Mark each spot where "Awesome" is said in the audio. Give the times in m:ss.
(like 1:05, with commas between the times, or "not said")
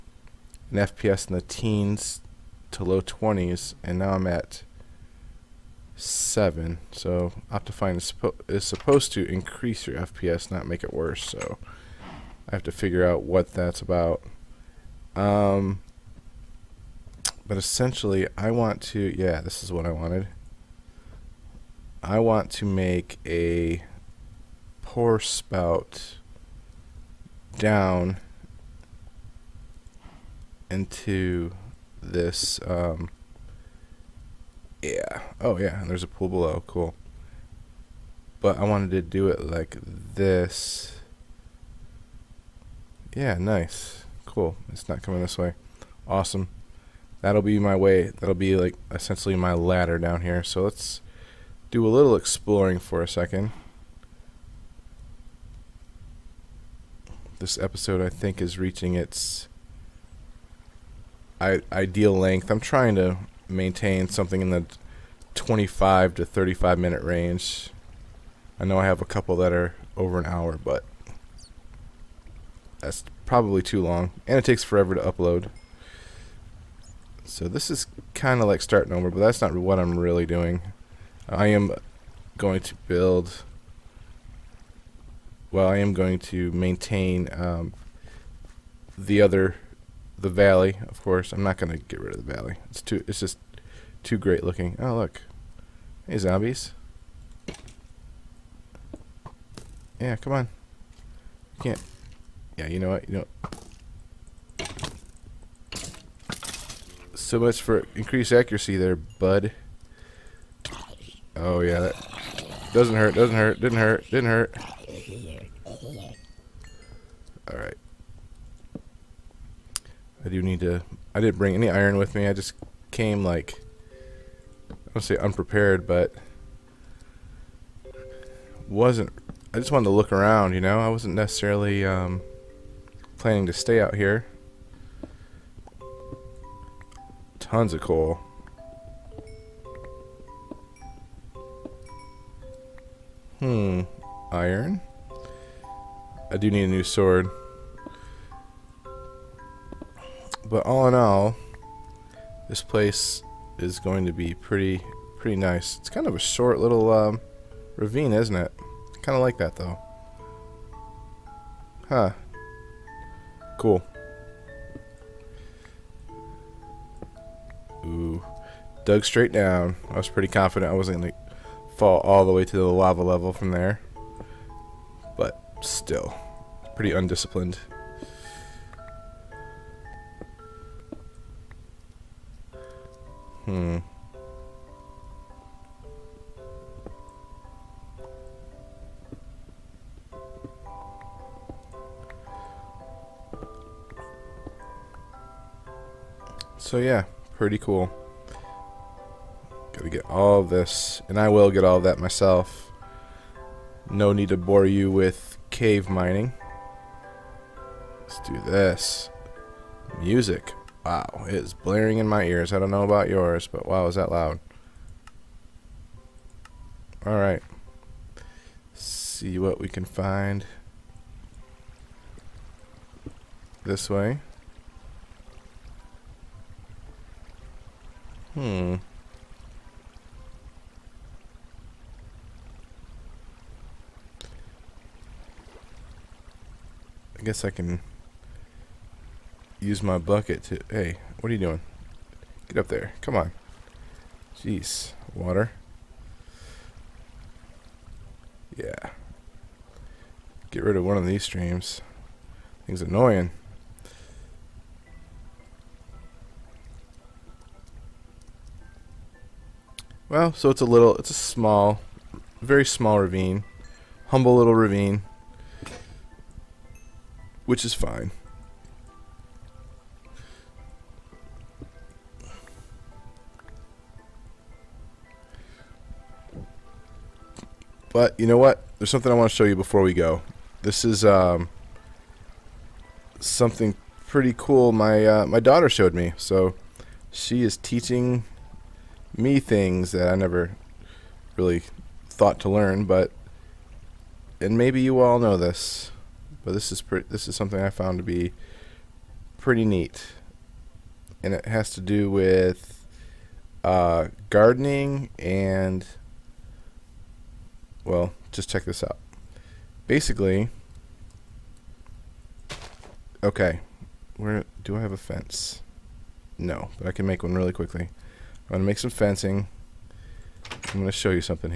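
0:46.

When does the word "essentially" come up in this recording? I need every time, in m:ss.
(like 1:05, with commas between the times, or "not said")
0:17, 0:48.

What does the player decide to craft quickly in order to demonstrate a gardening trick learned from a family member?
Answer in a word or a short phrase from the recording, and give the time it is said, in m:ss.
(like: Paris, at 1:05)
fencing, at 5:18.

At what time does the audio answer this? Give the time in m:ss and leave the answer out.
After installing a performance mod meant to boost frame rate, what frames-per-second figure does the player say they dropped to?
0:05.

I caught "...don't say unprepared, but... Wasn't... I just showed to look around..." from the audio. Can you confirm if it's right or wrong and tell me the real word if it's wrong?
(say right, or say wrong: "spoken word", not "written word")
wrong: "wanted", not "showed".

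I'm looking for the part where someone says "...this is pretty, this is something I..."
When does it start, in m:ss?
4:56.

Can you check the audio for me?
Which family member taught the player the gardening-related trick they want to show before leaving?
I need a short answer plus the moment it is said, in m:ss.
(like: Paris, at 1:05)
daughter, at 4:45.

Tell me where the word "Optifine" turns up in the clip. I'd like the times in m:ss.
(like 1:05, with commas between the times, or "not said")
0:07.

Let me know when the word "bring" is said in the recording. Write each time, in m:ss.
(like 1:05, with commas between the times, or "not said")
2:01.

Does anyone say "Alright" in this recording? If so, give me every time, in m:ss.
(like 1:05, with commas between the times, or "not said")
1:57, 3:37.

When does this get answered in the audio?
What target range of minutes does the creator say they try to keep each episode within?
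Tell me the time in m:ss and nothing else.
1:05.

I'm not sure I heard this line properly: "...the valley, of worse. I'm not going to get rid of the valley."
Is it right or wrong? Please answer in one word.
wrong.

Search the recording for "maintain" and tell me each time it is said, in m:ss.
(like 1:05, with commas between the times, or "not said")
1:03, 1:26.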